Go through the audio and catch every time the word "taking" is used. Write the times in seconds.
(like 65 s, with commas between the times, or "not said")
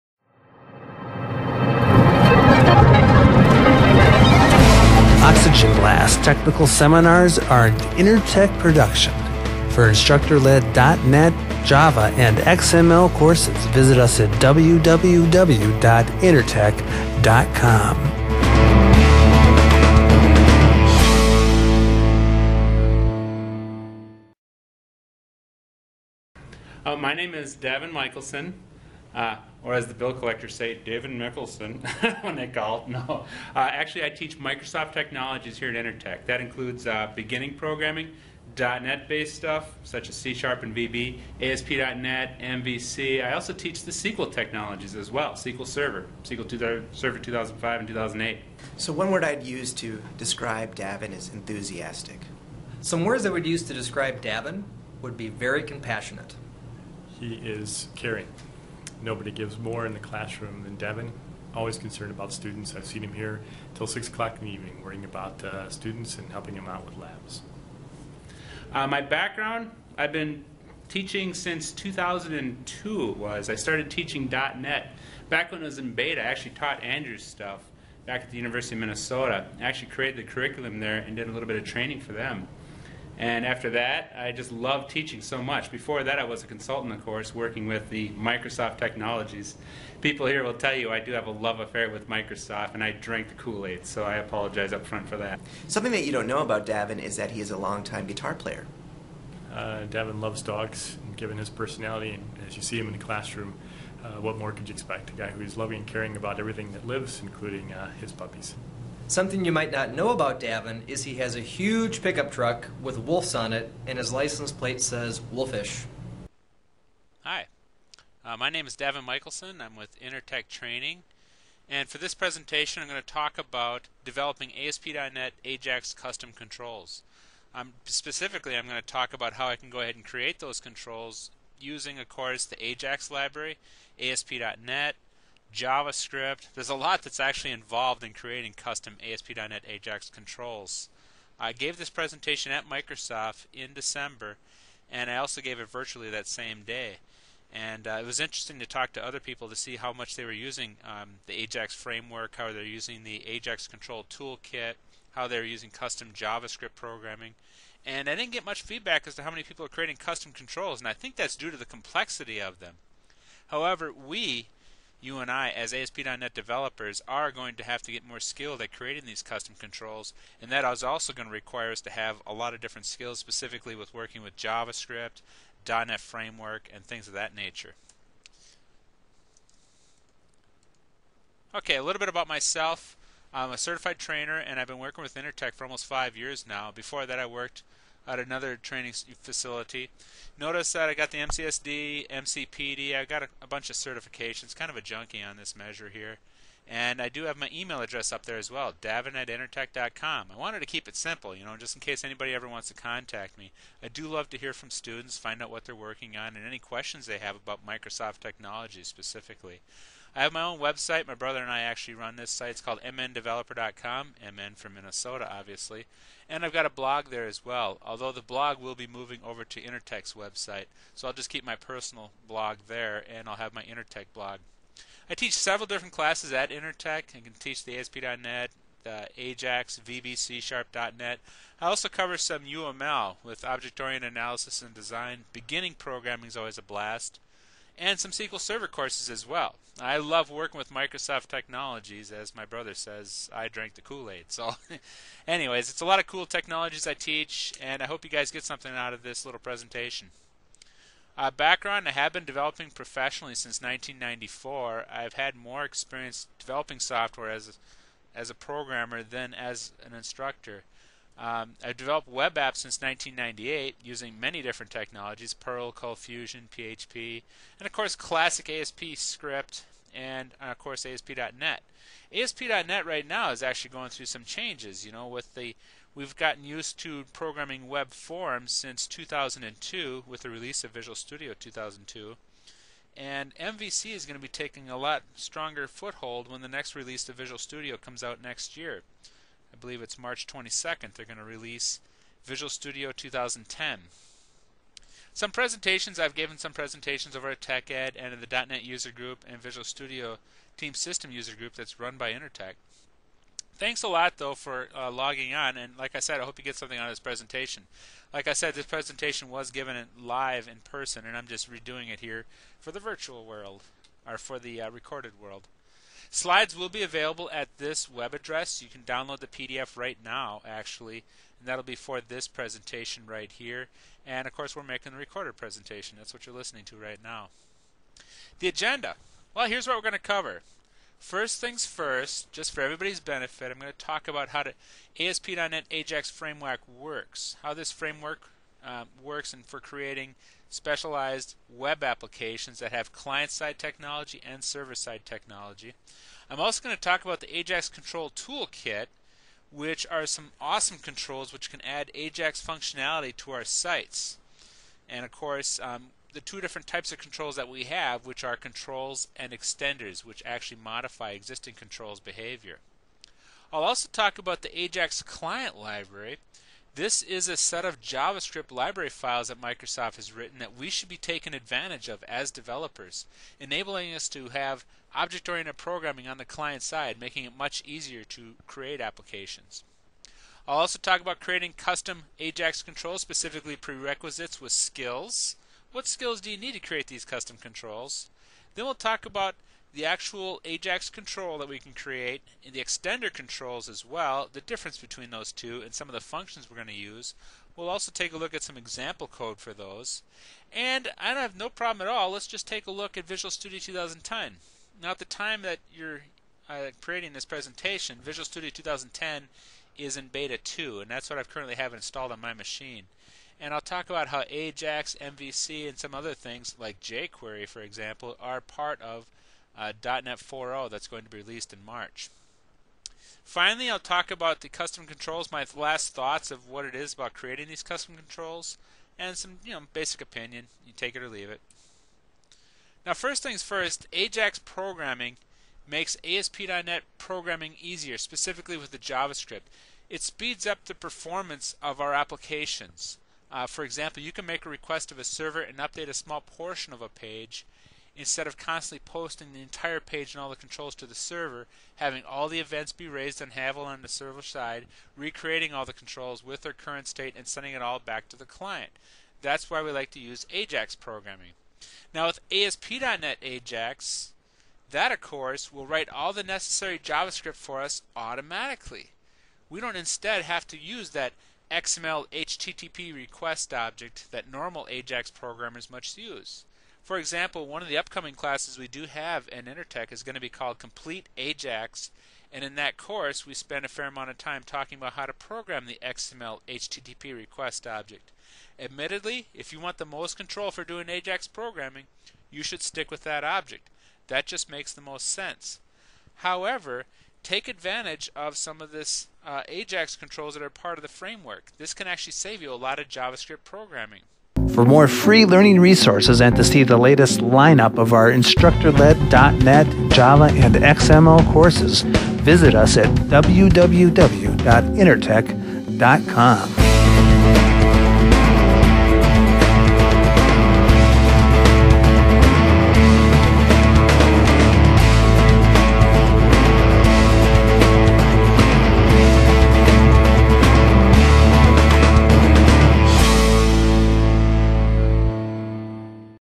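284 s, 370 s.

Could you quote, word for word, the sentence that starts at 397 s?
We'll also take a look at some example code for those.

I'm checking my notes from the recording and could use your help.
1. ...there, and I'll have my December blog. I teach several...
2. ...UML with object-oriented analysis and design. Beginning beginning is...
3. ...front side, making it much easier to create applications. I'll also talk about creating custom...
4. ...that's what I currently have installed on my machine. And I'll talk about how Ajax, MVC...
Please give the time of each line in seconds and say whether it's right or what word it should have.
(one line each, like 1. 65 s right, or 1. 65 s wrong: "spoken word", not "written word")
1. 222 s wrong: "Intertech", not "December"
2. 232 s wrong: "programming", not "beginning"
3. 376 s wrong: "client", not "front"
4. 410 s right.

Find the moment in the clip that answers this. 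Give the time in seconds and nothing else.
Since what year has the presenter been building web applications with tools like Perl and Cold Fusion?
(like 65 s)
262 s.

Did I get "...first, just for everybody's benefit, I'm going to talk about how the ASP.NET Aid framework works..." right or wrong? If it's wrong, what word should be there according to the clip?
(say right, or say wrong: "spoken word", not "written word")
wrong: "AJAX", not "Aid".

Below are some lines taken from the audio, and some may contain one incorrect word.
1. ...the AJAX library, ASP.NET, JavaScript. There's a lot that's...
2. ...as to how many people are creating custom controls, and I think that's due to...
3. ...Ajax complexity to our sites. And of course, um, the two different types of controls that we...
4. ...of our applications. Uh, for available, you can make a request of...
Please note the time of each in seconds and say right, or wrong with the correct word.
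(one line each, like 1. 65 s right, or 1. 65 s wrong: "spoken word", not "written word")
1. 132 s right
2. 159 s right
3. 351 s wrong: "functionality", not "complexity"
4. 441 s wrong: "example", not "available".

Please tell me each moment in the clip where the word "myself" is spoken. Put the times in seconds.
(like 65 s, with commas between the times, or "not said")
182 s.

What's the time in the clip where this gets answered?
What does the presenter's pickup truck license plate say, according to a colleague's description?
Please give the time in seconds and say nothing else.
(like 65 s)
115 s.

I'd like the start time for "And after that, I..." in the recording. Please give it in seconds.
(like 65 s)
83 s.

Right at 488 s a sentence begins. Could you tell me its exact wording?
Admittedly, if you want the most control for doing AJAX programming, you should stick with that object.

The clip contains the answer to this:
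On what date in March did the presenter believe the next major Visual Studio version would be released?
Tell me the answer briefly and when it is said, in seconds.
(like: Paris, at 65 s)
March 22nd, at 289 s.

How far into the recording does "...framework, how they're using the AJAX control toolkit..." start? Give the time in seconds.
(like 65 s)
151 s.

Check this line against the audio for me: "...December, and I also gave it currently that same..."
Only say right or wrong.
wrong.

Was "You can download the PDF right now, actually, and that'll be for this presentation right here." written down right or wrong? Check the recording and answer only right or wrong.
right.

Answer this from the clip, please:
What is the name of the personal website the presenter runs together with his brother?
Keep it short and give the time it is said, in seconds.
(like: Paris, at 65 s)
mndeveloper.com, at 212 s.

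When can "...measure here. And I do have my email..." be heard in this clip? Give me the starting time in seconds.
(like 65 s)
195 s.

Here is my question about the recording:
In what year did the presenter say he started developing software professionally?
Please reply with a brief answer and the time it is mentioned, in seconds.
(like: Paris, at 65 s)
1994, at 253 s.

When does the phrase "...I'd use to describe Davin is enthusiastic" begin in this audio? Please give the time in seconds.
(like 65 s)
49 s.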